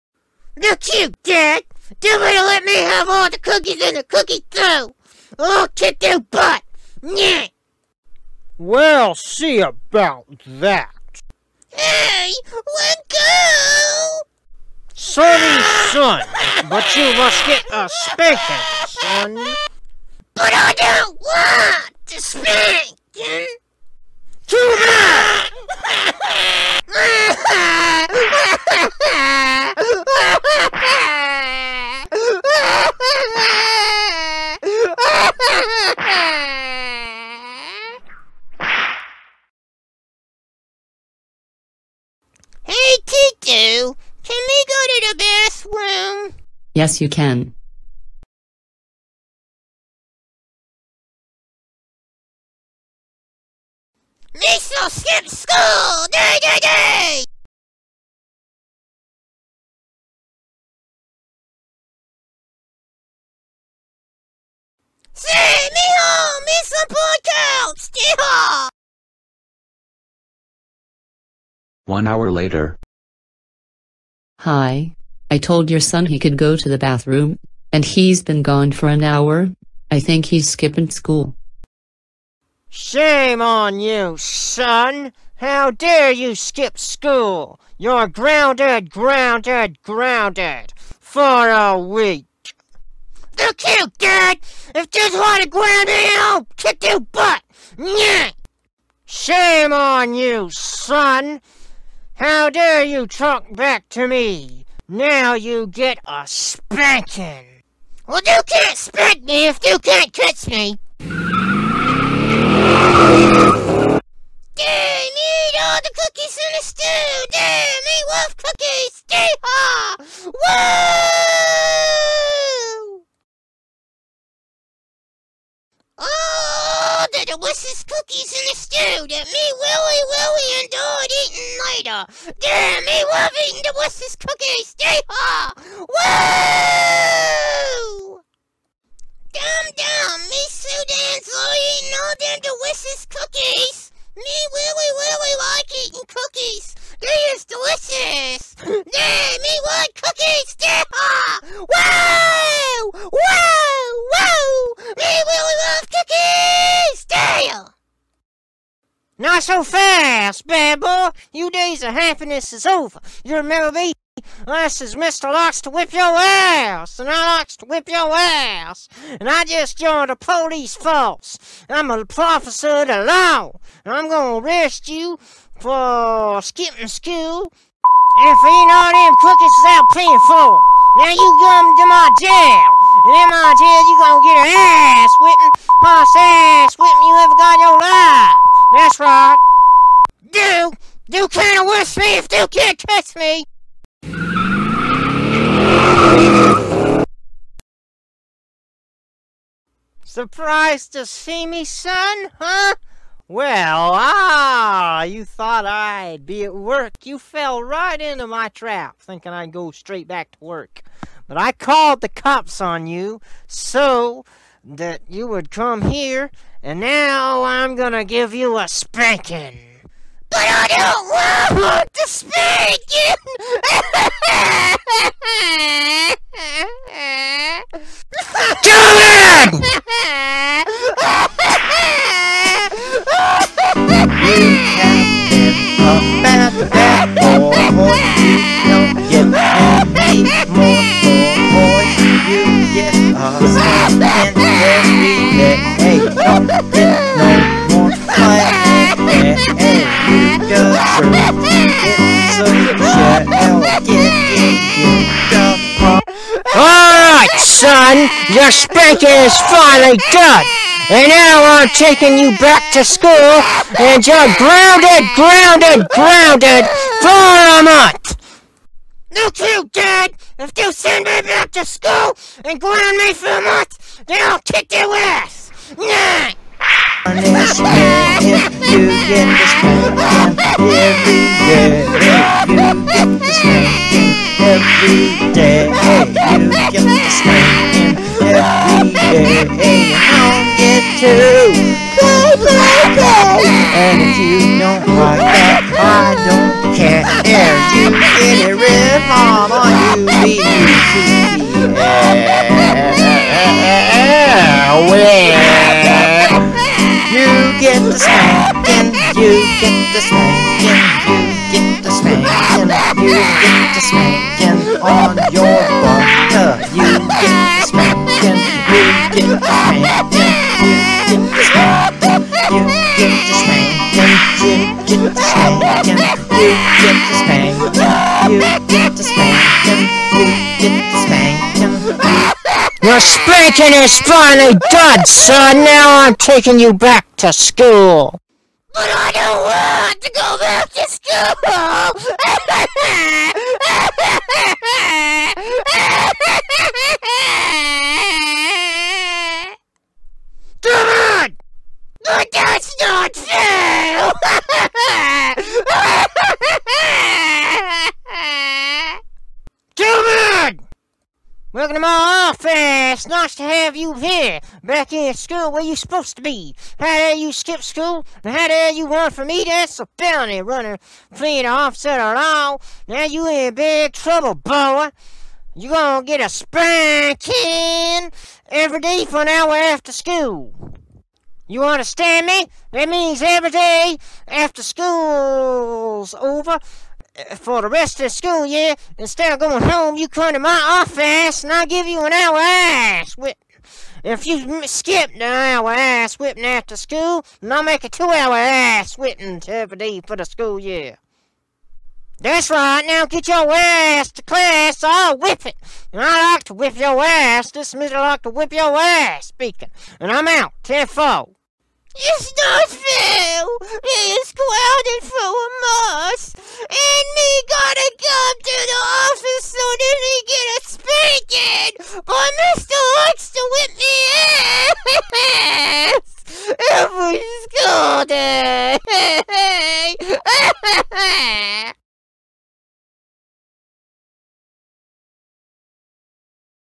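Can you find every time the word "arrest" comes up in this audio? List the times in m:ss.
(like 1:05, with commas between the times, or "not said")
2:54, 3:11.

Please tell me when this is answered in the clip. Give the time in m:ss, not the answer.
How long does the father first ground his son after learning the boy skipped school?
1:31.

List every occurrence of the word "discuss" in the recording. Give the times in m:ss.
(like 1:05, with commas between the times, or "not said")
not said.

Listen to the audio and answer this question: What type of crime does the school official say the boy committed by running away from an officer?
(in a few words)
A felony.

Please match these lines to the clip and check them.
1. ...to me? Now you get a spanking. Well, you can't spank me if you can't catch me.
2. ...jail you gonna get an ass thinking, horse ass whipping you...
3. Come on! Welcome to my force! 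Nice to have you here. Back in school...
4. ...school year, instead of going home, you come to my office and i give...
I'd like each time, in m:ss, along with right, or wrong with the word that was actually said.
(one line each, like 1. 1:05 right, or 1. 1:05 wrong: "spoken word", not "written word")
1. 1:43 right
2. 3:03 wrong: "whipping", not "thinking"
3. 5:59 wrong: "office", not "force"
4. 6:28 right.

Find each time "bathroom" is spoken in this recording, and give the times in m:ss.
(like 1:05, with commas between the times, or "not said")
0:45, 1:16.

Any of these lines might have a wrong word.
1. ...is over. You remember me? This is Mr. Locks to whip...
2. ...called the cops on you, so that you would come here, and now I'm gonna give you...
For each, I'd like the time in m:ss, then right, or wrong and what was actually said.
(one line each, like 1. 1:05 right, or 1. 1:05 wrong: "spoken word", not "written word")
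1. 2:42 right
2. 3:31 right.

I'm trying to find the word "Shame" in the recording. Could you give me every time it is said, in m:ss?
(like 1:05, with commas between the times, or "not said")
1:22, 1:39.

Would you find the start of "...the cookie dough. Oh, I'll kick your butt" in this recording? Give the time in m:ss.
0:03.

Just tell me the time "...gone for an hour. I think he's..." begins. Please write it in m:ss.
1:18.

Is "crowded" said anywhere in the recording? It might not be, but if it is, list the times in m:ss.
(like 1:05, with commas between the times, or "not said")
6:54.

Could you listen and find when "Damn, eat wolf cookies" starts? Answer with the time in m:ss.
1:57.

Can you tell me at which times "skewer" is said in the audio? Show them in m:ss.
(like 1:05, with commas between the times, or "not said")
not said.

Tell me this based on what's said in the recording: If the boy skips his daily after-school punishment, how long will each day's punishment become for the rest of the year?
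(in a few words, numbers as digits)
2 hours.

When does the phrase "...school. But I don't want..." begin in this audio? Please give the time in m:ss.
5:37.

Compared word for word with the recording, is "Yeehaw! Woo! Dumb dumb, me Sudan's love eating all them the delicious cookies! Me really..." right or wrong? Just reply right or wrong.
right.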